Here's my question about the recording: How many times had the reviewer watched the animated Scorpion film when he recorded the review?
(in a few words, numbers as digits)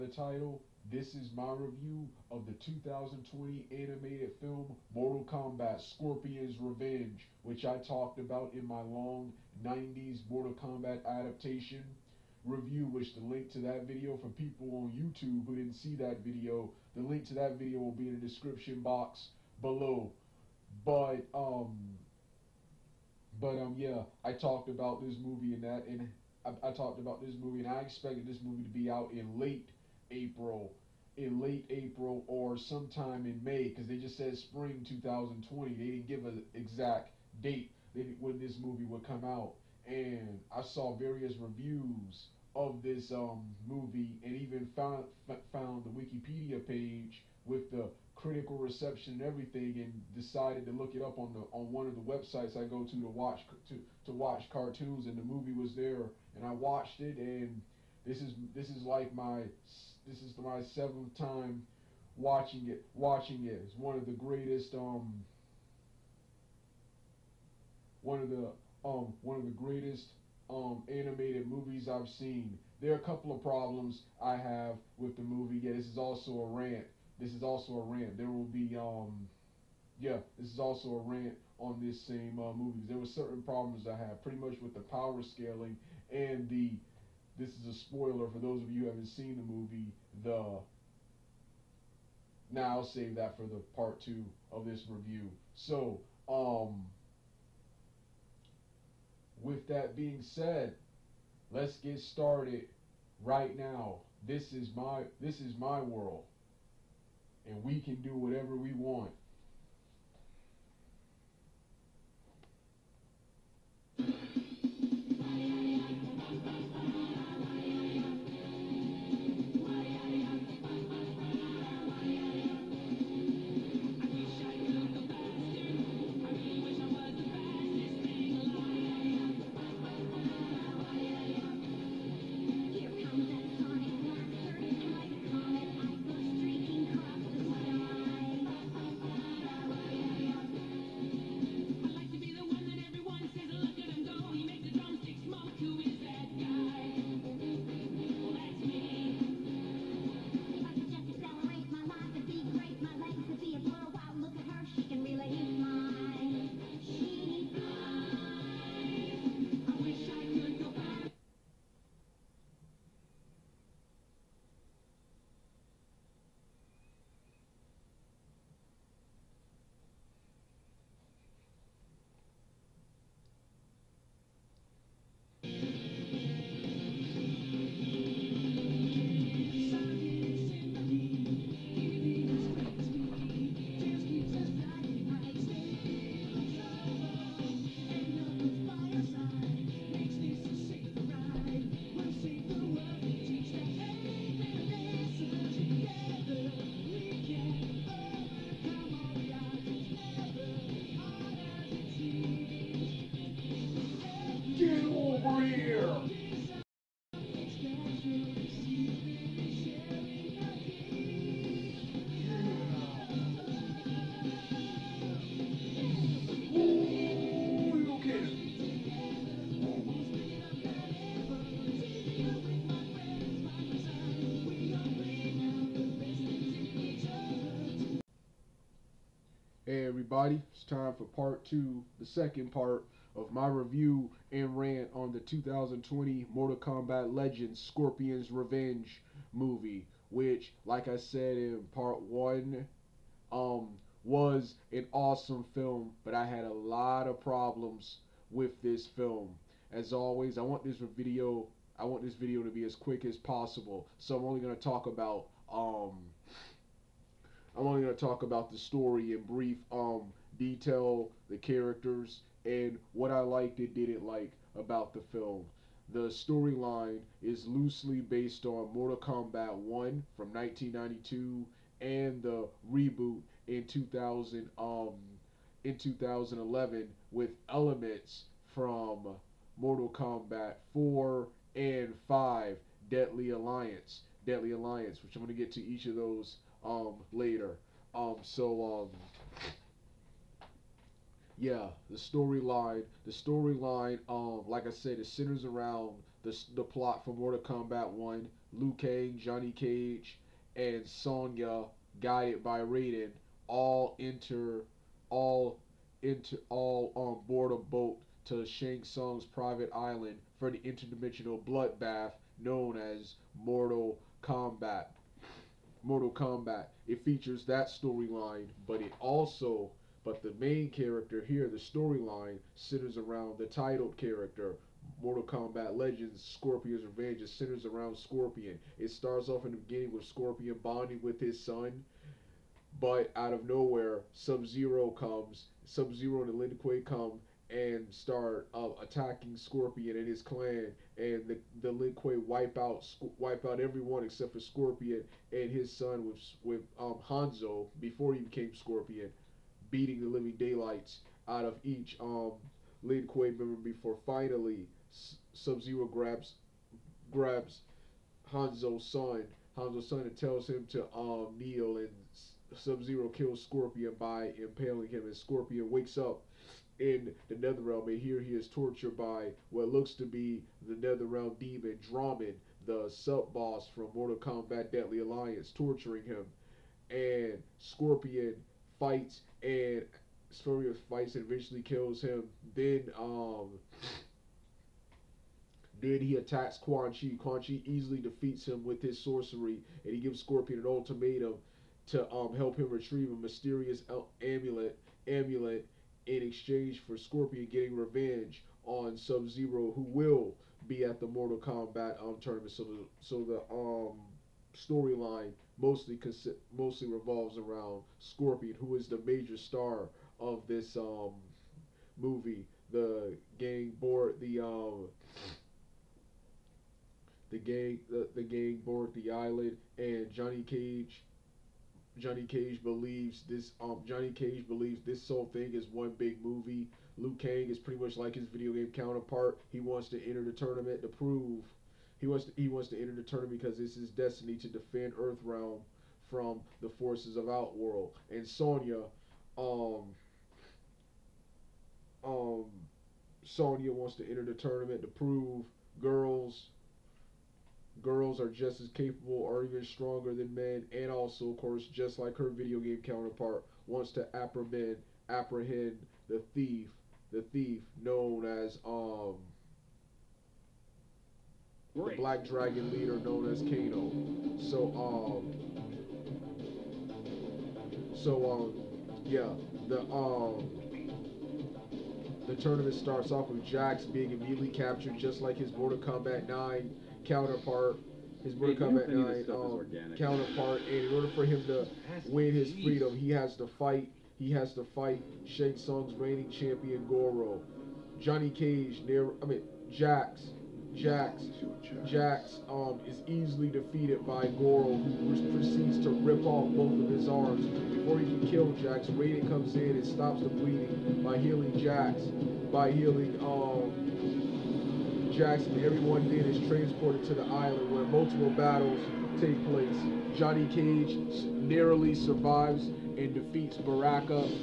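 7.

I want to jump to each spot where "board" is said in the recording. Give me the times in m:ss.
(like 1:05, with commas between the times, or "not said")
5:07, 6:53, 6:58.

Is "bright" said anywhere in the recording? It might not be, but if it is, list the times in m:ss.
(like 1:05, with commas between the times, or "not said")
not said.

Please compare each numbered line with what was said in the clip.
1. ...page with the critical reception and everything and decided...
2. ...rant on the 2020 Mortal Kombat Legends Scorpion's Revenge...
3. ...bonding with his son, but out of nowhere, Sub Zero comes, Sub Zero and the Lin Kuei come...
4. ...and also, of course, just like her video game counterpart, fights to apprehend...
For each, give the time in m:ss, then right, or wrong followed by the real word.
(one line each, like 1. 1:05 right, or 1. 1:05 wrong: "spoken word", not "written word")
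1. 0:46 right
2. 3:54 right
3. 5:30 right
4. 7:30 wrong: "wants", not "fights".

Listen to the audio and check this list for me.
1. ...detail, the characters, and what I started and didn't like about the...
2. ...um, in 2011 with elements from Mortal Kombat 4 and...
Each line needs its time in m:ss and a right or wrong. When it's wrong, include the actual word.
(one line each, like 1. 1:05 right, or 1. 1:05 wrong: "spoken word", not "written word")
1. 4:20 wrong: "liked", not "started"
2. 4:34 right.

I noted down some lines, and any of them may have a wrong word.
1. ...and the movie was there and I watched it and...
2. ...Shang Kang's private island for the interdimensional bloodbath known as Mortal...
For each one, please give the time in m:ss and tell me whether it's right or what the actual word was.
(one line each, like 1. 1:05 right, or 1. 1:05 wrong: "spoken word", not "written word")
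1. 0:55 right
2. 5:08 wrong: "Tsung", not "Kang".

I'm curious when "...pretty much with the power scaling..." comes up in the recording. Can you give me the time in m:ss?
1:24.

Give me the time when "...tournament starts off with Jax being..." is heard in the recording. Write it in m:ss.
7:52.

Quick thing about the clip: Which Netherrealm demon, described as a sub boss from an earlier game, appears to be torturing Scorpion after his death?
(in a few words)
Drahmin.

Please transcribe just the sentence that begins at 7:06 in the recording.
Liu Kang is pretty much like his video game counterpart.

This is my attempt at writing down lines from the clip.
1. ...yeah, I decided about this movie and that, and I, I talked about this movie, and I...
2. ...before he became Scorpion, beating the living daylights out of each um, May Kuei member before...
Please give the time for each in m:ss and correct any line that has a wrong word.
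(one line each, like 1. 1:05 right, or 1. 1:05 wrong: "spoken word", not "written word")
1. 0:23 wrong: "talked", not "decided"
2. 5:47 wrong: "Lin", not "May".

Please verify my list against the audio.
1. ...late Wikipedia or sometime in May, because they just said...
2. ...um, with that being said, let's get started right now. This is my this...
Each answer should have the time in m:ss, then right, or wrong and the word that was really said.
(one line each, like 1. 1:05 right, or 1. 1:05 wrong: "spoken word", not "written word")
1. 0:31 wrong: "April", not "Wikipedia"
2. 1:36 right.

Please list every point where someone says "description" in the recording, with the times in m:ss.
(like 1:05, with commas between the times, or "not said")
0:18.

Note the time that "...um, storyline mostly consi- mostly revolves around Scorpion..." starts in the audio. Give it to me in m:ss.
6:43.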